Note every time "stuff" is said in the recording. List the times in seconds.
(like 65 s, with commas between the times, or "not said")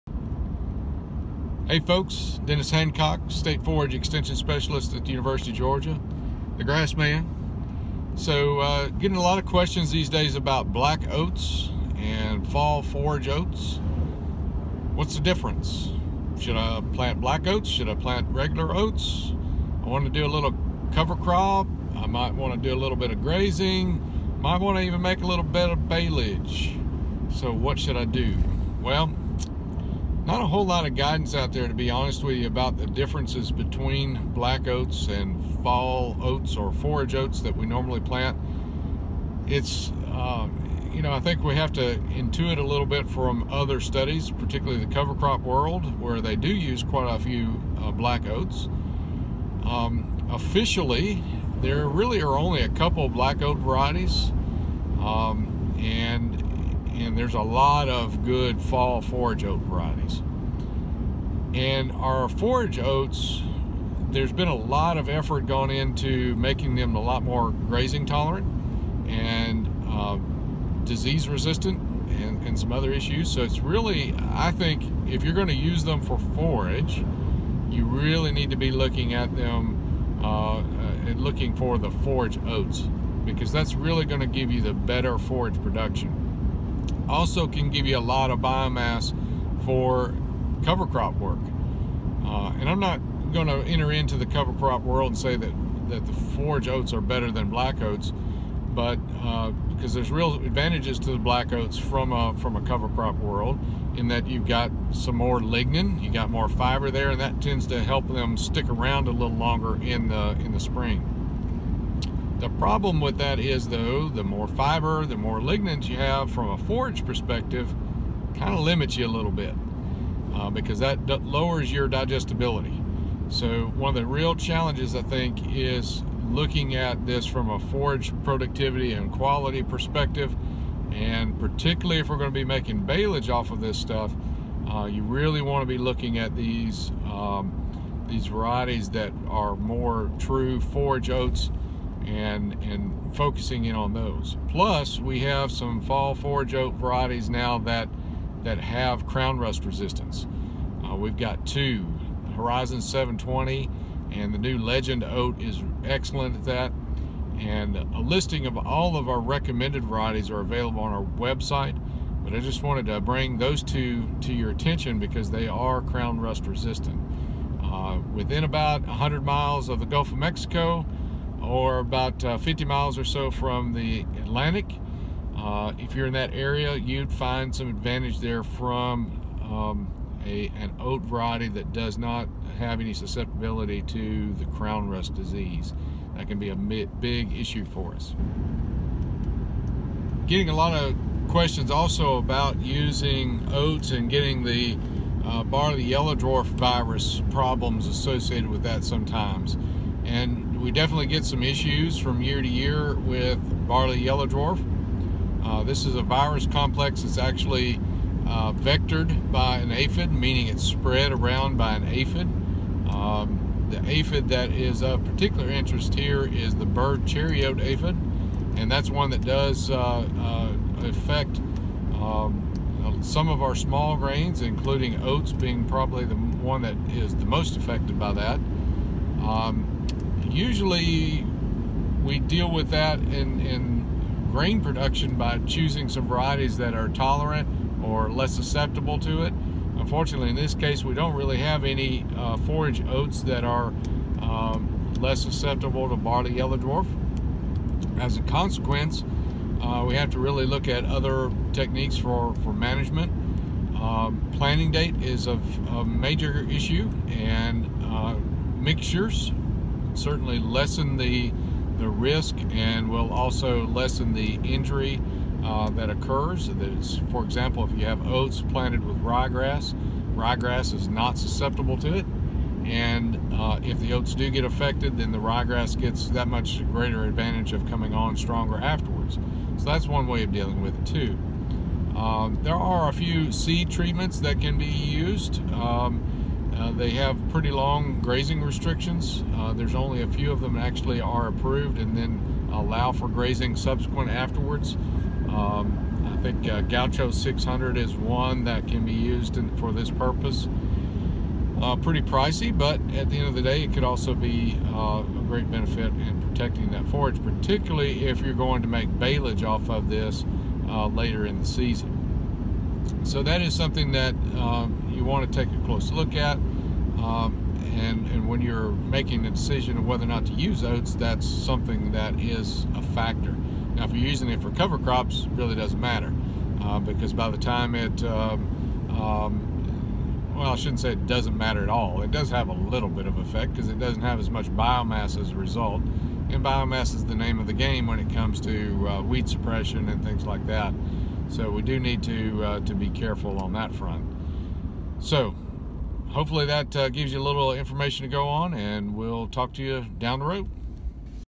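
133 s.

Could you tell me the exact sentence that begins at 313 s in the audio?
So that is something that um, you want to take a close look at.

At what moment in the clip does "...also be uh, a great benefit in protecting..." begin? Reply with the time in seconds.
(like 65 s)
303 s.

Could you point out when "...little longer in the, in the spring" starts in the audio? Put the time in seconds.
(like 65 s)
109 s.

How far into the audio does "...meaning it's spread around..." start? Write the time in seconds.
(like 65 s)
210 s.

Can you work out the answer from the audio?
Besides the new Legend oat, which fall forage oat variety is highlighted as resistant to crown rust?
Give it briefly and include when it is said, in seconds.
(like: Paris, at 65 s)
Horizon 720, at 152 s.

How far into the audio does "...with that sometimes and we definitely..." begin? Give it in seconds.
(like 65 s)
198 s.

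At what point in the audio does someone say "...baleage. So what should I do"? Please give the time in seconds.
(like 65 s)
25 s.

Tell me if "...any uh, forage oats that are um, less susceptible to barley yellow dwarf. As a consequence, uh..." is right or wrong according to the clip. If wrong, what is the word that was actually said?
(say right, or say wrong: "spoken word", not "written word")
right.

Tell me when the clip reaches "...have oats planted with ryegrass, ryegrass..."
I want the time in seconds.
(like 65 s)
267 s.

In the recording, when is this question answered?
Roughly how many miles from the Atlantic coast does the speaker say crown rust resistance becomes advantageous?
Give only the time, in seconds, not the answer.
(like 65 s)
172 s.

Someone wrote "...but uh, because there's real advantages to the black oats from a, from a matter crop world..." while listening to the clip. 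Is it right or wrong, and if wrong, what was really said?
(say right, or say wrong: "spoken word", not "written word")
wrong: "cover", not "matter".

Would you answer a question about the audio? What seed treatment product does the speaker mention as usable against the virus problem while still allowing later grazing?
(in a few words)
Gaucho 600.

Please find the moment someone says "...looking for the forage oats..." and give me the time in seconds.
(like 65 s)
81 s.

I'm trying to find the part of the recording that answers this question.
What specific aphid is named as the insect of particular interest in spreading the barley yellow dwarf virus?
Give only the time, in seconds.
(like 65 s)
216 s.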